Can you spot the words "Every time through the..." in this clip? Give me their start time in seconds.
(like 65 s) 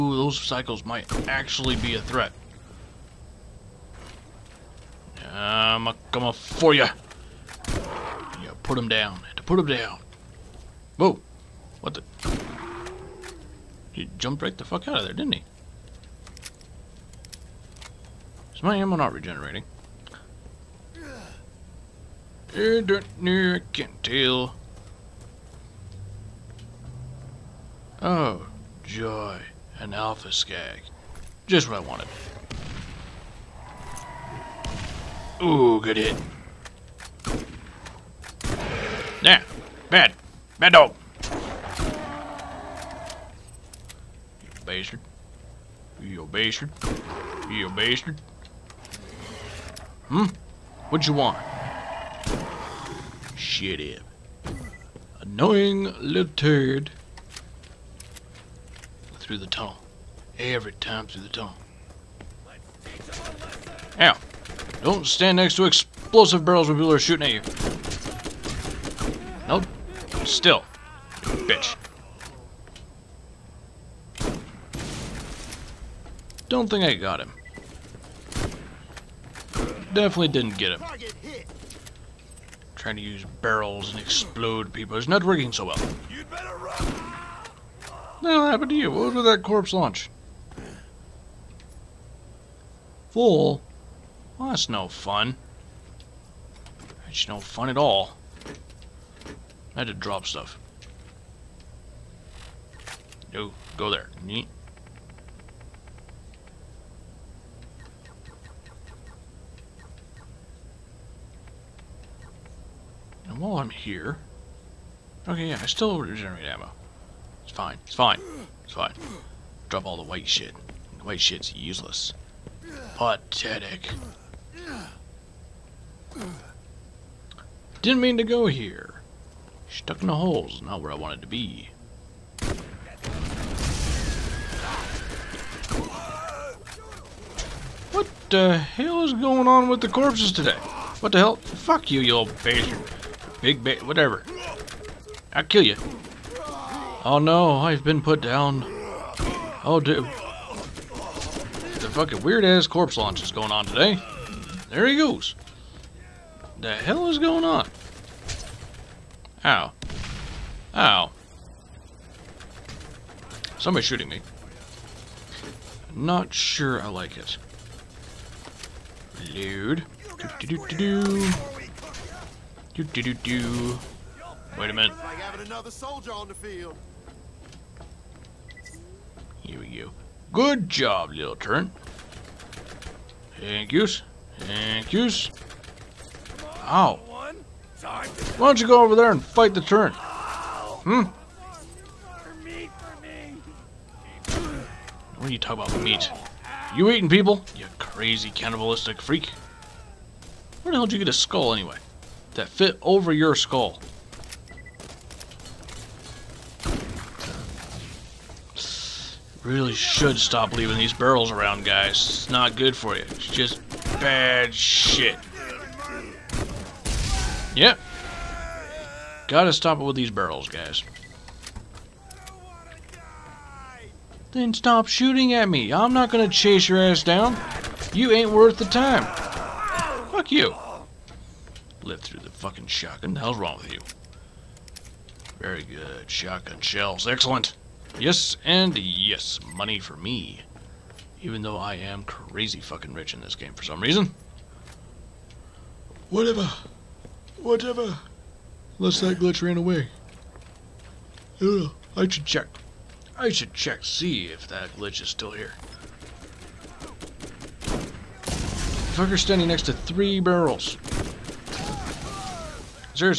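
60 s.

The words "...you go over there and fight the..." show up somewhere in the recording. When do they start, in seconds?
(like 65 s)
188 s.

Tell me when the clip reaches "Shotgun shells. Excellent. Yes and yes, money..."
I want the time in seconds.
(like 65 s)
236 s.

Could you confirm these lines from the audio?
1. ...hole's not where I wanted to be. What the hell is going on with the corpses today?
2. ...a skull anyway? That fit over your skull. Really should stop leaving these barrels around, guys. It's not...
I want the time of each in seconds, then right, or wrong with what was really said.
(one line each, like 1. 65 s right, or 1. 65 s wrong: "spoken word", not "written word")
1. 130 s right
2. 201 s right.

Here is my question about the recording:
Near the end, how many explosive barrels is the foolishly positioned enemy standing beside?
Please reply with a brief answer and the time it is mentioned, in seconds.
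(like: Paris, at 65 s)
3, at 259 s.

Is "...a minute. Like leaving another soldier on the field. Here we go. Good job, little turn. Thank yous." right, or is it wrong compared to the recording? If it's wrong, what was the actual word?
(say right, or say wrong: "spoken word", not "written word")
wrong: "having", not "leaving".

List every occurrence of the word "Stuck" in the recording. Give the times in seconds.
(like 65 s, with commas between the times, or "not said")
129 s.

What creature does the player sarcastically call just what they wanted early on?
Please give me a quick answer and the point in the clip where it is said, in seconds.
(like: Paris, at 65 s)
Alpha skag, at 29 s.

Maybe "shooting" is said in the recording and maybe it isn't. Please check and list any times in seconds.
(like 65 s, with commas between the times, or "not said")
66 s, 163 s, 224 s.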